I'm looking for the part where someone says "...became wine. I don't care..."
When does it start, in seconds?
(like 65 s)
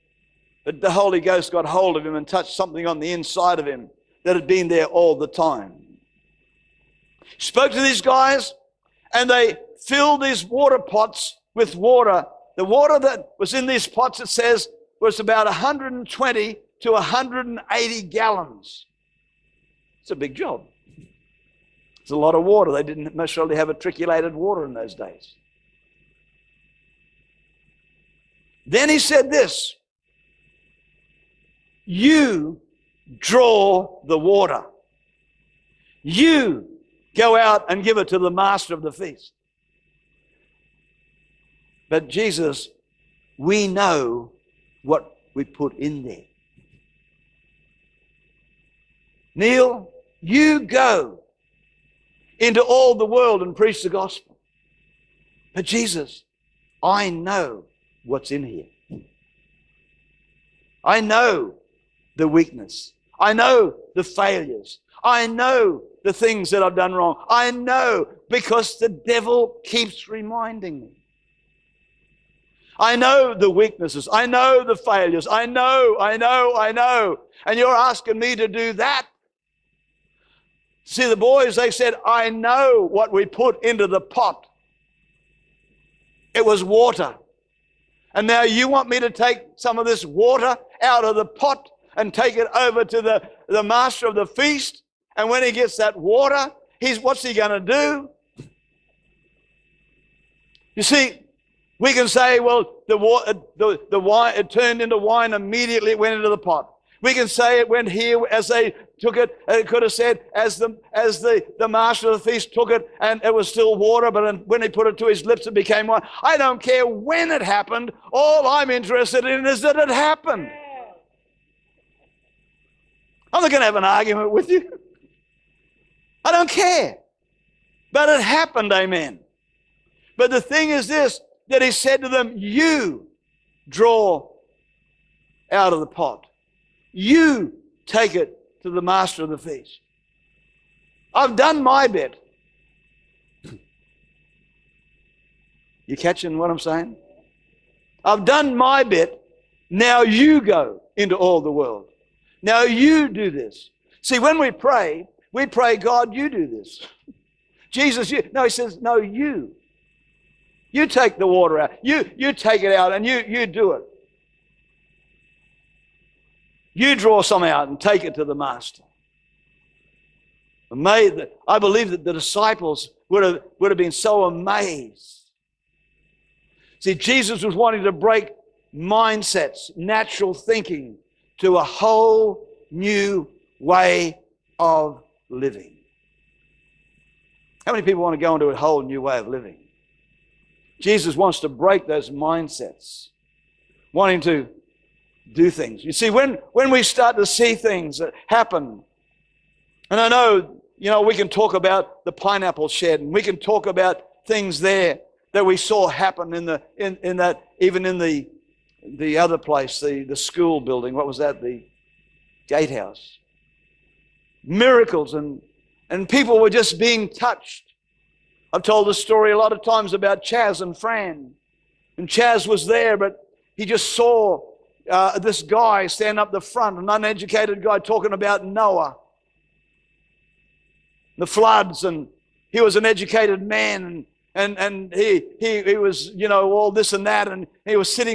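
115 s.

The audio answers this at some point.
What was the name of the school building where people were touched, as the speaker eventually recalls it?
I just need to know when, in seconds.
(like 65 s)
211 s.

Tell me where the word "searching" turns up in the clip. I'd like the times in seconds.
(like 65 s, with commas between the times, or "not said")
not said.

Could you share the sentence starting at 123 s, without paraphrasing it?
I'm not going to have an argument with you.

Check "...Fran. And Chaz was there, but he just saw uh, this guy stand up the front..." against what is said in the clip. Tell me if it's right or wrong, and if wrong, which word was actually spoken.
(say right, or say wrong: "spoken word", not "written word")
right.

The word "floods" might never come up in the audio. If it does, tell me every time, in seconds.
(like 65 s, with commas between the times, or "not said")
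231 s.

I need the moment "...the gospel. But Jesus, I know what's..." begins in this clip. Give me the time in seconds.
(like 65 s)
53 s.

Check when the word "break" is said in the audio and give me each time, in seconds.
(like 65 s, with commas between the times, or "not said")
177 s, 191 s.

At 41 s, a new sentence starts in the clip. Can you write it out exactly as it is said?
But Jesus, we know what we put in there.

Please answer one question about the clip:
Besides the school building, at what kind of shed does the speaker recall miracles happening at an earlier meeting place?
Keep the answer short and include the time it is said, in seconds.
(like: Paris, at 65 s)
Pineapple shed, at 202 s.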